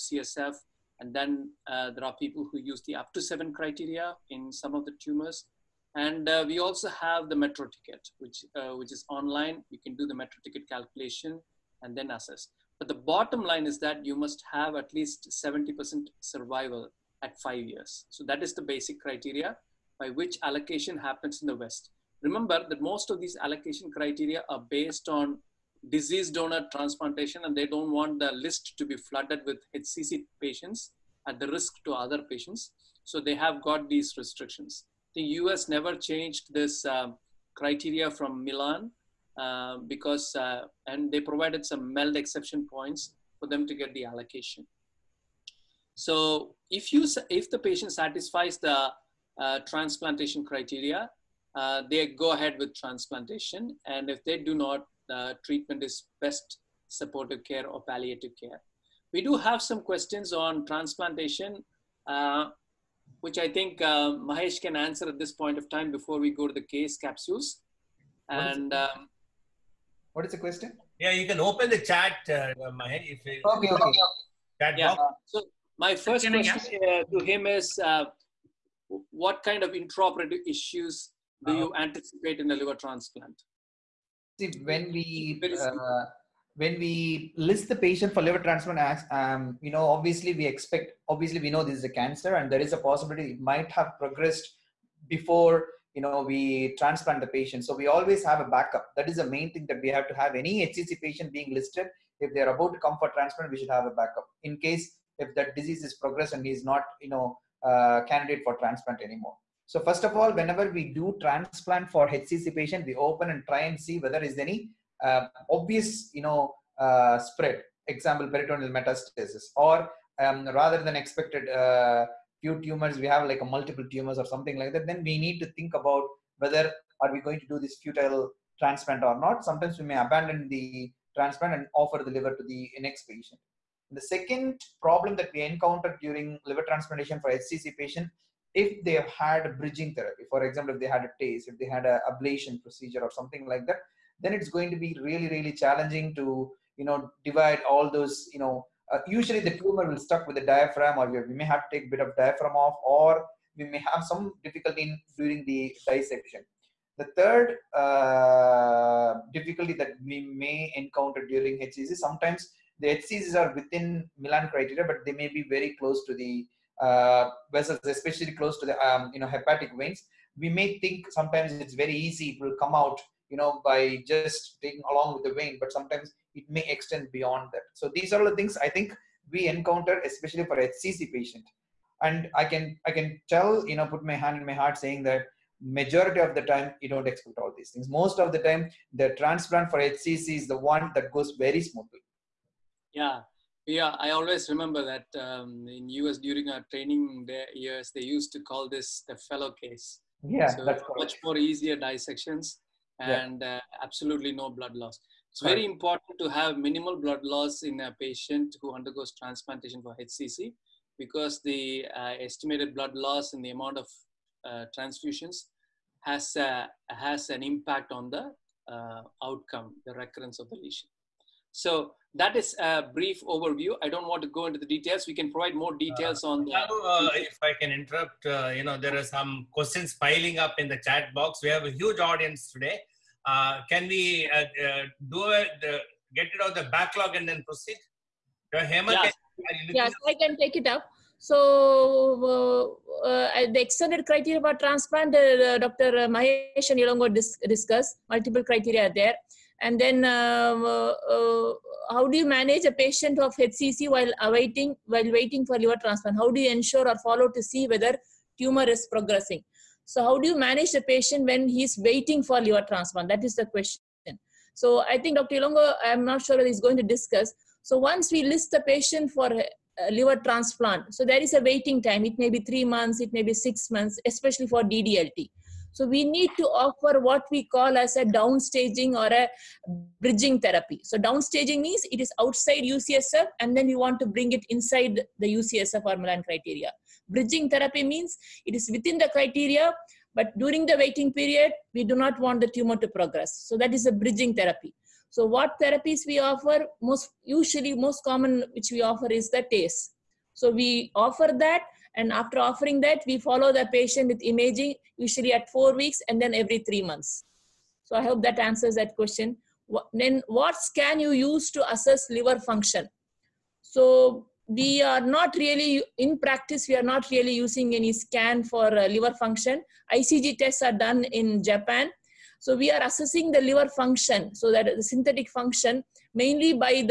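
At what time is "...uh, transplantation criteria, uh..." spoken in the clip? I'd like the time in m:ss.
0:49.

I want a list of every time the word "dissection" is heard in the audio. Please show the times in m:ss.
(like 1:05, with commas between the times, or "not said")
2:35, 3:21.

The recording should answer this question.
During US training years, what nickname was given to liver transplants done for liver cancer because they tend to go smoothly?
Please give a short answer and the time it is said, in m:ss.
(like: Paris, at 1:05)
The fellow case, at 3:19.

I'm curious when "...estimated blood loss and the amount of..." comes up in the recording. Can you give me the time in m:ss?
3:32.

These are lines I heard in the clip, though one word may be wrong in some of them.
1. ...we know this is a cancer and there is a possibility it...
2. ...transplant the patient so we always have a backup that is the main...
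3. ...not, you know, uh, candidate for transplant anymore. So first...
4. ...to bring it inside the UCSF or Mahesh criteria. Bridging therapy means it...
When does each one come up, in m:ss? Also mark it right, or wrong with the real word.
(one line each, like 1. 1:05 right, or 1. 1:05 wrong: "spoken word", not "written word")
1. 1:31 right
2. 1:36 right
3. 1:46 right
4. 4:44 wrong: "Milan", not "Mahesh".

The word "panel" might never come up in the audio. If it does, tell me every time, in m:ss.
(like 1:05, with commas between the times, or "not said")
not said.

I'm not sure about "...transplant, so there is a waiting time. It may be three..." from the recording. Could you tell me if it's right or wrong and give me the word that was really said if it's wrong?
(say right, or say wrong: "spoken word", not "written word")
right.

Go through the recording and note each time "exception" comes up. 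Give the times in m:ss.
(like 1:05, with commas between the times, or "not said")
0:42.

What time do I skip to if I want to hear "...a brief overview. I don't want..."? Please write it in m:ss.
3:42.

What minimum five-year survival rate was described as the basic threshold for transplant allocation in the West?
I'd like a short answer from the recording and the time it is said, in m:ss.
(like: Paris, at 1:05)
70%, at 0:15.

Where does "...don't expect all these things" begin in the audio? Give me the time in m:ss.
3:06.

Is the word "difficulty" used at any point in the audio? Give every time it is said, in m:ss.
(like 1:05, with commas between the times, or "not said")
2:34, 2:39.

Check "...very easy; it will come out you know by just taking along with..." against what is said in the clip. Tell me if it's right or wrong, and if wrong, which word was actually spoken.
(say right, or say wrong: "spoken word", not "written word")
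right.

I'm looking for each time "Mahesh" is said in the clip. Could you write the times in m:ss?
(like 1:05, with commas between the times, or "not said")
1:04, 1:12, 4:06.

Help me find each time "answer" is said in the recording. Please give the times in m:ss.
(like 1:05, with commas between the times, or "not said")
1:04, 5:08.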